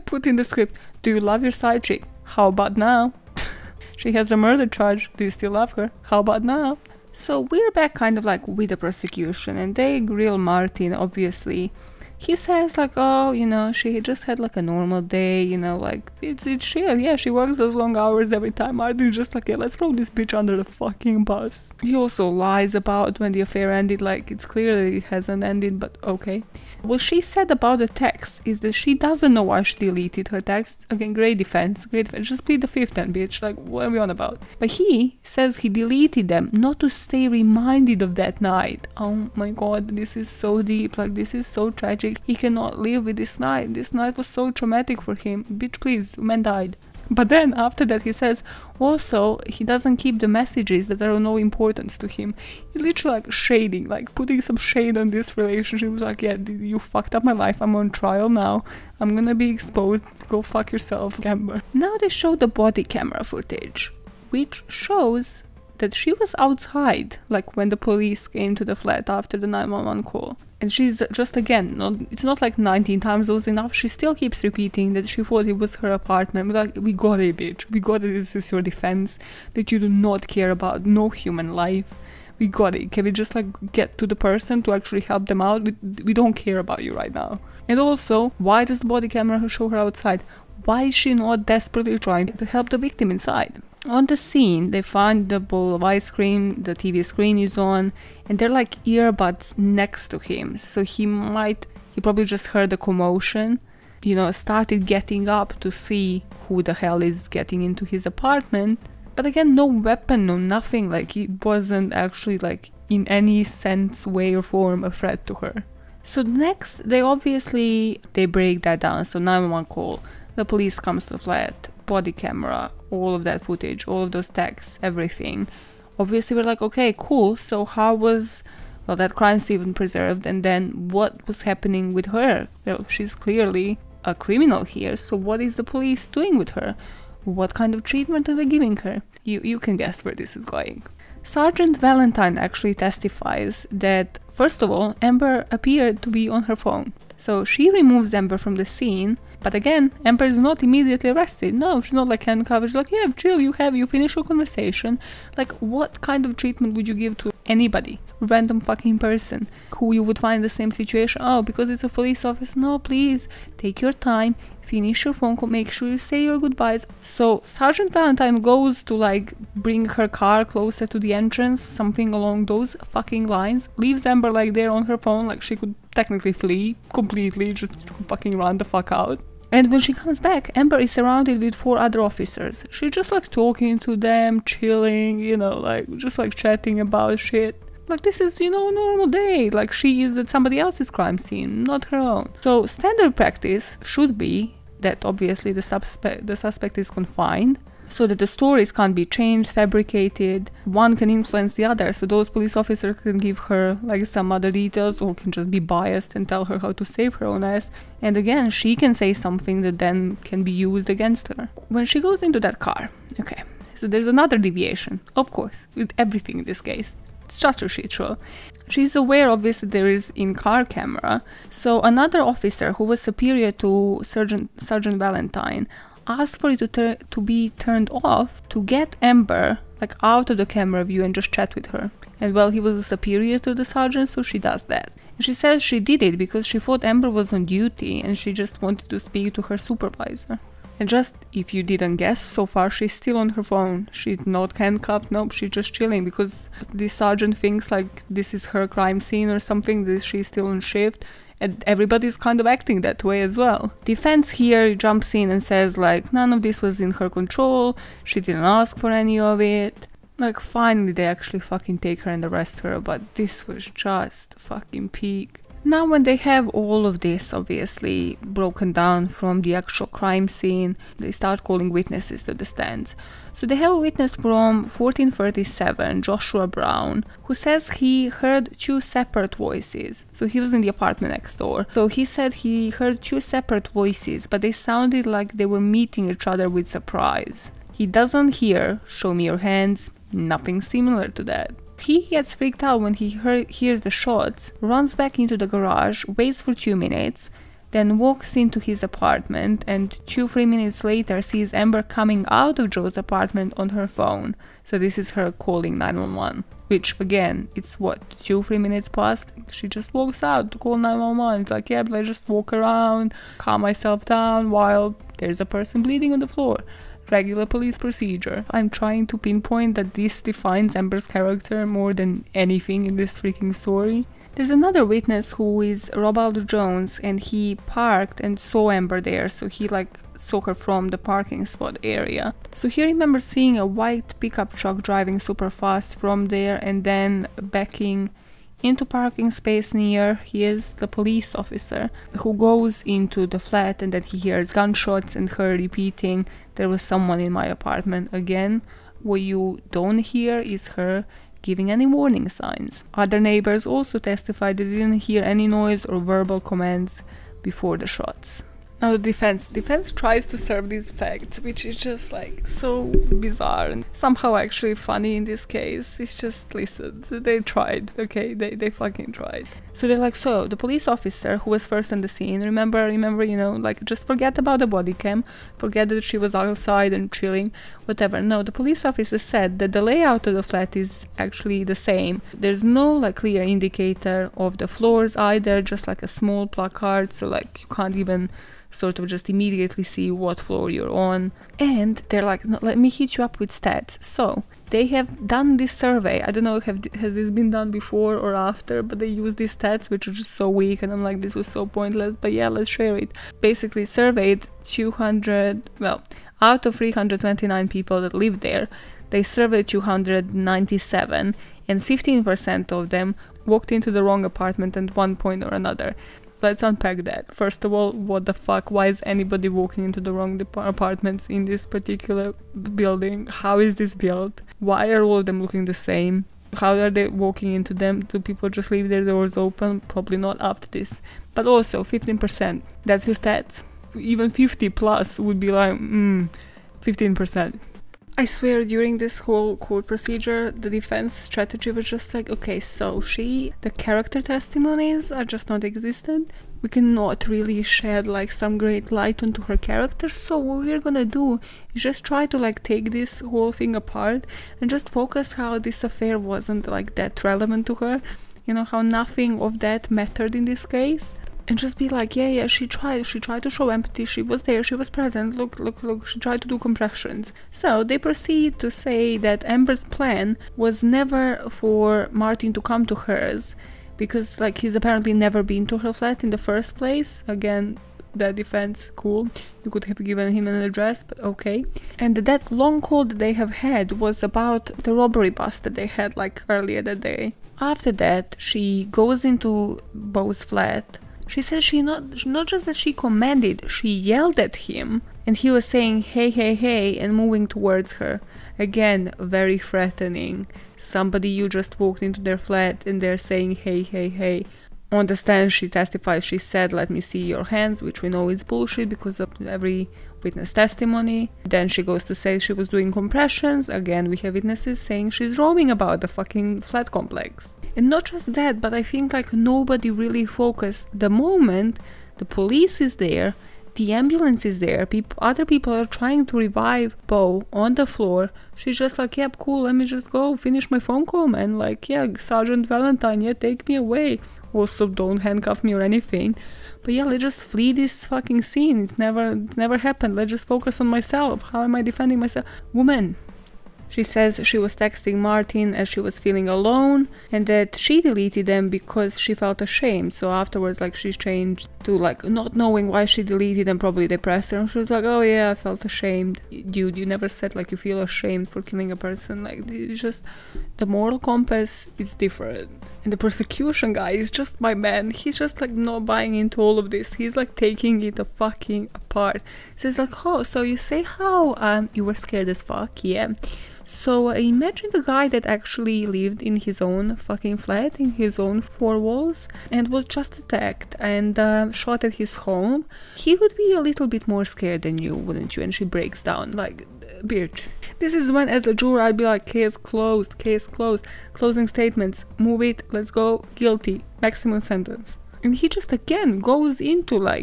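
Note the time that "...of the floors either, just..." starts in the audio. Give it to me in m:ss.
6:24.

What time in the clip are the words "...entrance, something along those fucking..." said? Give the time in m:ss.
2:51.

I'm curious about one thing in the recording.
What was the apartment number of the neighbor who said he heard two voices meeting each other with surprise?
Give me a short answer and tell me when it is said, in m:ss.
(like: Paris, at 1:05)
1437, at 4:34.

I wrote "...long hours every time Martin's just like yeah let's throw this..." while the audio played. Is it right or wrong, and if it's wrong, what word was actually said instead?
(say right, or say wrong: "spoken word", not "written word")
wrong: "Arden", not "Martin".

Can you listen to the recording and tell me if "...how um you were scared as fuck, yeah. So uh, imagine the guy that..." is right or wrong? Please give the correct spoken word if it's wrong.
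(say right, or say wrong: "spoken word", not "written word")
right.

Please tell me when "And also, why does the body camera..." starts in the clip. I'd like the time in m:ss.
1:27.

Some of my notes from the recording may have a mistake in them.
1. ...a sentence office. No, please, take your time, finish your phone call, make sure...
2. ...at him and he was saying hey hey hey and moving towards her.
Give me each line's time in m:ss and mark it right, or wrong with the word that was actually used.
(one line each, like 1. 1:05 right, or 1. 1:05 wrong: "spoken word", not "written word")
1. 2:41 wrong: "police", not "sentence"
2. 8:14 right.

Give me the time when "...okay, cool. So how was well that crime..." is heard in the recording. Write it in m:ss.
2:06.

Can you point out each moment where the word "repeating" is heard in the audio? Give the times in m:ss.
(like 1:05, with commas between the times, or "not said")
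1:14, 5:45.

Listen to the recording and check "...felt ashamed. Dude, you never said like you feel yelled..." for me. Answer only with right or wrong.
wrong.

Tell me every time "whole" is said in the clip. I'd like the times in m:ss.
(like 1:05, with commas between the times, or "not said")
7:19, 7:33.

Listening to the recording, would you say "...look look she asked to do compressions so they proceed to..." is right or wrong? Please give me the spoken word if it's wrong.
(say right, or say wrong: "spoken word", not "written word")
wrong: "tried", not "asked".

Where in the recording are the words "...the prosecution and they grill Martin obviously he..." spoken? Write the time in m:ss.
0:08.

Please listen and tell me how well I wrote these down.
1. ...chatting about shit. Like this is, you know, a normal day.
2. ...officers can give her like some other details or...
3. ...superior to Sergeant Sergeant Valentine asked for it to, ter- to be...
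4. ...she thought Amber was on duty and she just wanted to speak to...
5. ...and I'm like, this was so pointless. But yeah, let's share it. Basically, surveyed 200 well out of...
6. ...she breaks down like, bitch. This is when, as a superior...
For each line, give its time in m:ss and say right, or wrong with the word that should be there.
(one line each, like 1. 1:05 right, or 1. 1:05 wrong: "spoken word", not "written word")
1. 3:06 right
2. 3:22 right
3. 3:43 right
4. 3:56 right
5. 6:40 right
6. 9:45 wrong: "juror", not "superior".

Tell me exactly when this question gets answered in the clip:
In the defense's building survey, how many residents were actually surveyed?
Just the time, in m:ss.
6:49.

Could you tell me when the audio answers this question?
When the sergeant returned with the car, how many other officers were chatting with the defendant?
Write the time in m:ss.
3:01.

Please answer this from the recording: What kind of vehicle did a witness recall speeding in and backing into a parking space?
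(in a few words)
white pickup truck.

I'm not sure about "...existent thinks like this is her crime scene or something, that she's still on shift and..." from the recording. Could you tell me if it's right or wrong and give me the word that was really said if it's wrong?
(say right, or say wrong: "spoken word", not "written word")
wrong: "sergeant", not "existent".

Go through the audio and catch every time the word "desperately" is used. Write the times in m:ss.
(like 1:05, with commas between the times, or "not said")
1:31.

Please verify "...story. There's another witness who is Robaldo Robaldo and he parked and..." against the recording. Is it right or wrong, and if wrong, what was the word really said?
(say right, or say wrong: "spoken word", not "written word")
wrong: "Jones", not "Robaldo".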